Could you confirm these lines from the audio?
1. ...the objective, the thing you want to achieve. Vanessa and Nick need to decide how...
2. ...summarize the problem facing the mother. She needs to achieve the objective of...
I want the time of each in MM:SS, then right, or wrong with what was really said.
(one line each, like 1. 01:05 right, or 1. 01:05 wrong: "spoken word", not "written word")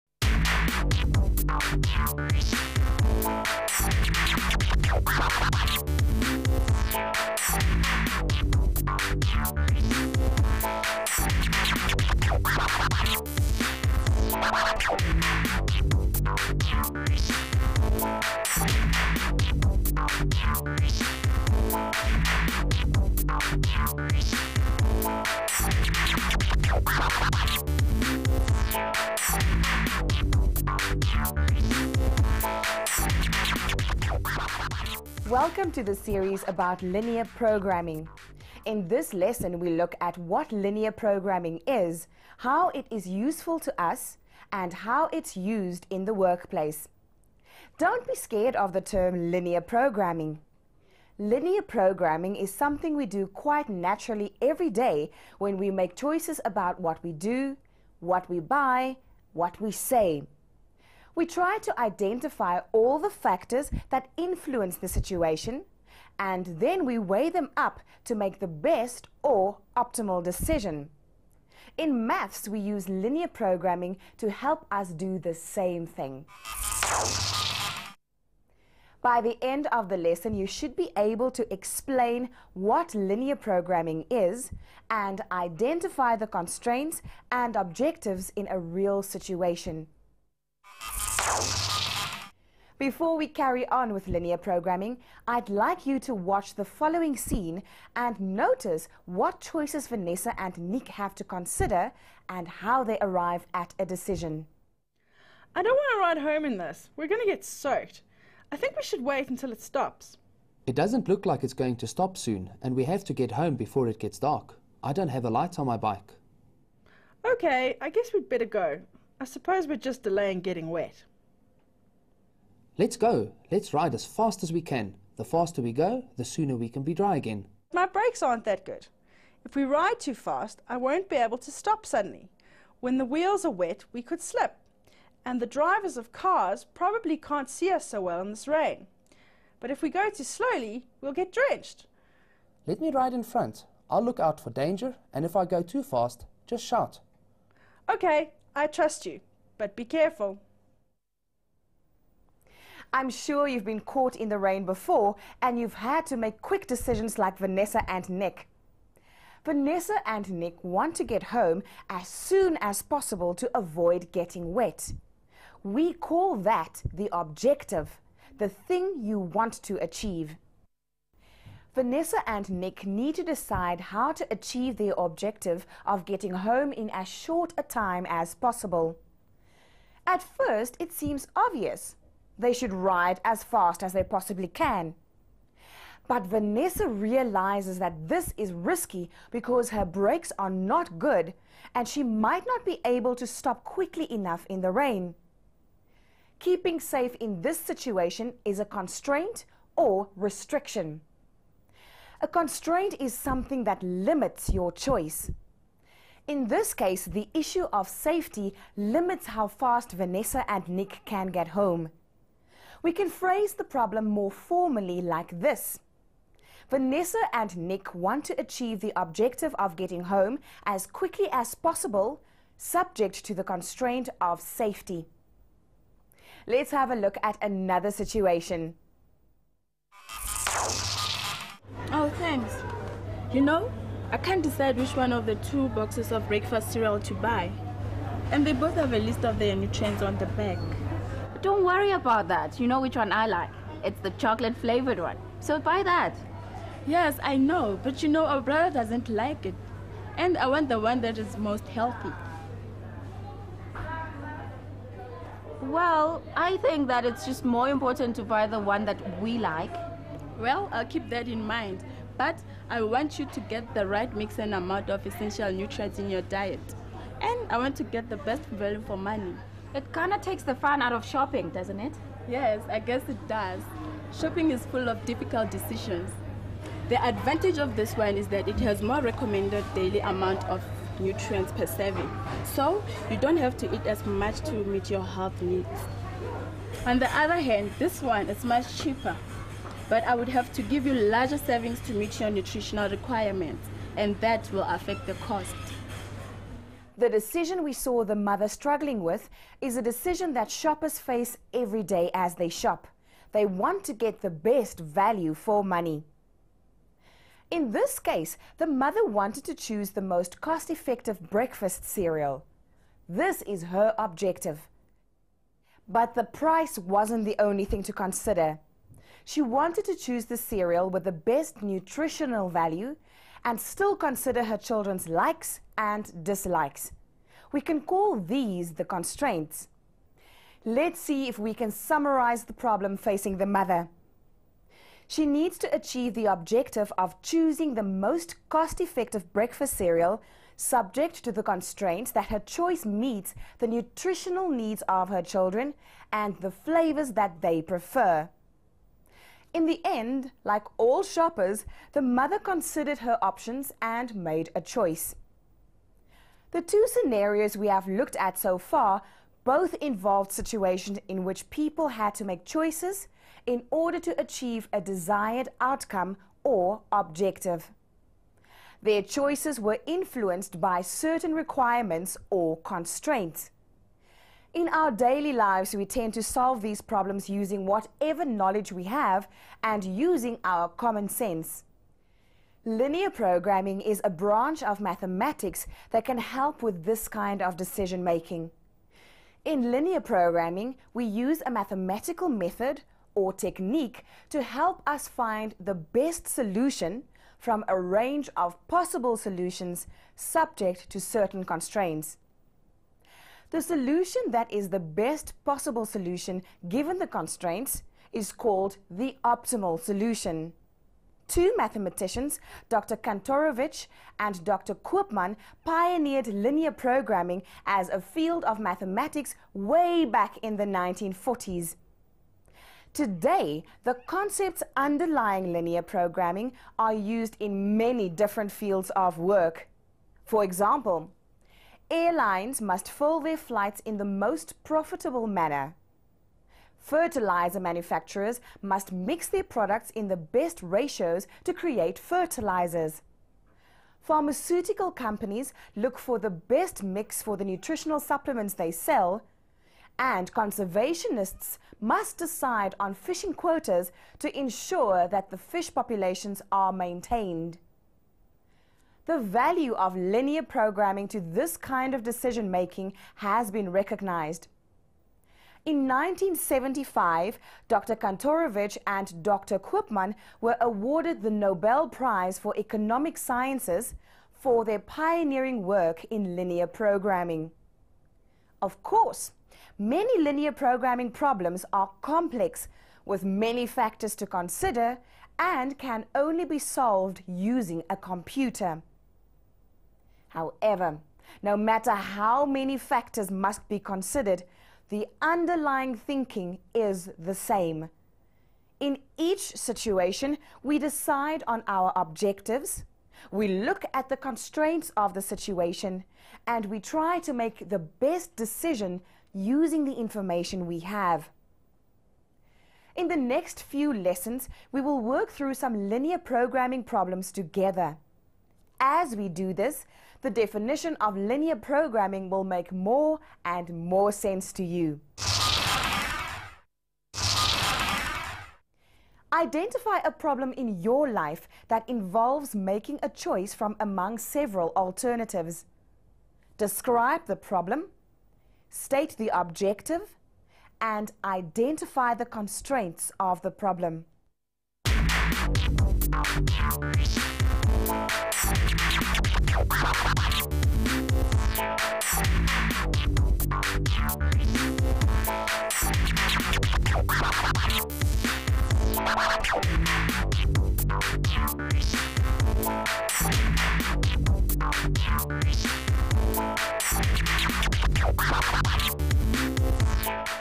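1. 02:46 right
2. 05:31 right.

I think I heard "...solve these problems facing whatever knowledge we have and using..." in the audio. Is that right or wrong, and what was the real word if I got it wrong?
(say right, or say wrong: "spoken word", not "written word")
wrong: "using", not "facing".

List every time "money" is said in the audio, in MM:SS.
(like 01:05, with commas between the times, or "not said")
04:28, 05:05.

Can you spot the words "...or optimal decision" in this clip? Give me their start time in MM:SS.
01:09.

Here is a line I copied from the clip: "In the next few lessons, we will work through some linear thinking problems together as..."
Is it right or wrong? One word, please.
wrong.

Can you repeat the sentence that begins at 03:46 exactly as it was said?
Let's have a look at another situation.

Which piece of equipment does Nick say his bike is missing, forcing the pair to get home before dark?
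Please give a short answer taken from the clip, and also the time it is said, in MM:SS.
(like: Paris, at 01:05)
A light, at 01:55.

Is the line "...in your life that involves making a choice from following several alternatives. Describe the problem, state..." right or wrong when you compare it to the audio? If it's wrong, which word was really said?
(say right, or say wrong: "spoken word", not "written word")
wrong: "among", not "following".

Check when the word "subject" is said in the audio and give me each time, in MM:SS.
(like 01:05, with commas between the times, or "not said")
03:42, 05:40, 06:40.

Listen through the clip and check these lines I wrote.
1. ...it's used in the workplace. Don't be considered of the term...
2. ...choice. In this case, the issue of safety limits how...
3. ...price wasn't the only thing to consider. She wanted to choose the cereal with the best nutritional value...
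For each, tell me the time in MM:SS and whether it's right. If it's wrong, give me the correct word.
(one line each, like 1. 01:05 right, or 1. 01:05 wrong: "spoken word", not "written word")
1. 00:45 wrong: "scared", not "considered"
2. 03:24 right
3. 05:16 right.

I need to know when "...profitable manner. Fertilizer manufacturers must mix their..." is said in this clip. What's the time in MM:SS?
07:14.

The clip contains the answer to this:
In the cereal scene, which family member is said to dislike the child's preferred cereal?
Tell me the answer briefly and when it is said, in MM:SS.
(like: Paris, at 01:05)
Brother, at 04:08.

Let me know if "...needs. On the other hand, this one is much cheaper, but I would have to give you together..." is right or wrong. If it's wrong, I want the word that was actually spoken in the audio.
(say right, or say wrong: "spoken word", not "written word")
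wrong: "larger", not "together".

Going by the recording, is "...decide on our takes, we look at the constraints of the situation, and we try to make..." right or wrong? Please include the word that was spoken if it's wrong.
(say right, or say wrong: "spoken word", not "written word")
wrong: "objectives", not "takes".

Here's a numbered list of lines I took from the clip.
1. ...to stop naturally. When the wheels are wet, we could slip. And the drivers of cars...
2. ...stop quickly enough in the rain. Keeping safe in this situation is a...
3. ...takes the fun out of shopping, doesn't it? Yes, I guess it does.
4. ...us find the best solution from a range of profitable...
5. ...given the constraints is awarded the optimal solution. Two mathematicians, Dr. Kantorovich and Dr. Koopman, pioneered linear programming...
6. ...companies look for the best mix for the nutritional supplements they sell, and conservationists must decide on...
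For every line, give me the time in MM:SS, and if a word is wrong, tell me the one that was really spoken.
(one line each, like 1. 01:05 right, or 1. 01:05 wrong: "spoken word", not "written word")
1. 02:11 wrong: "suddenly", not "naturally"
2. 03:13 right
3. 04:30 right
4. 06:34 wrong: "possible", not "profitable"
5. 06:46 wrong: "called", not "awarded"
6. 07:24 right.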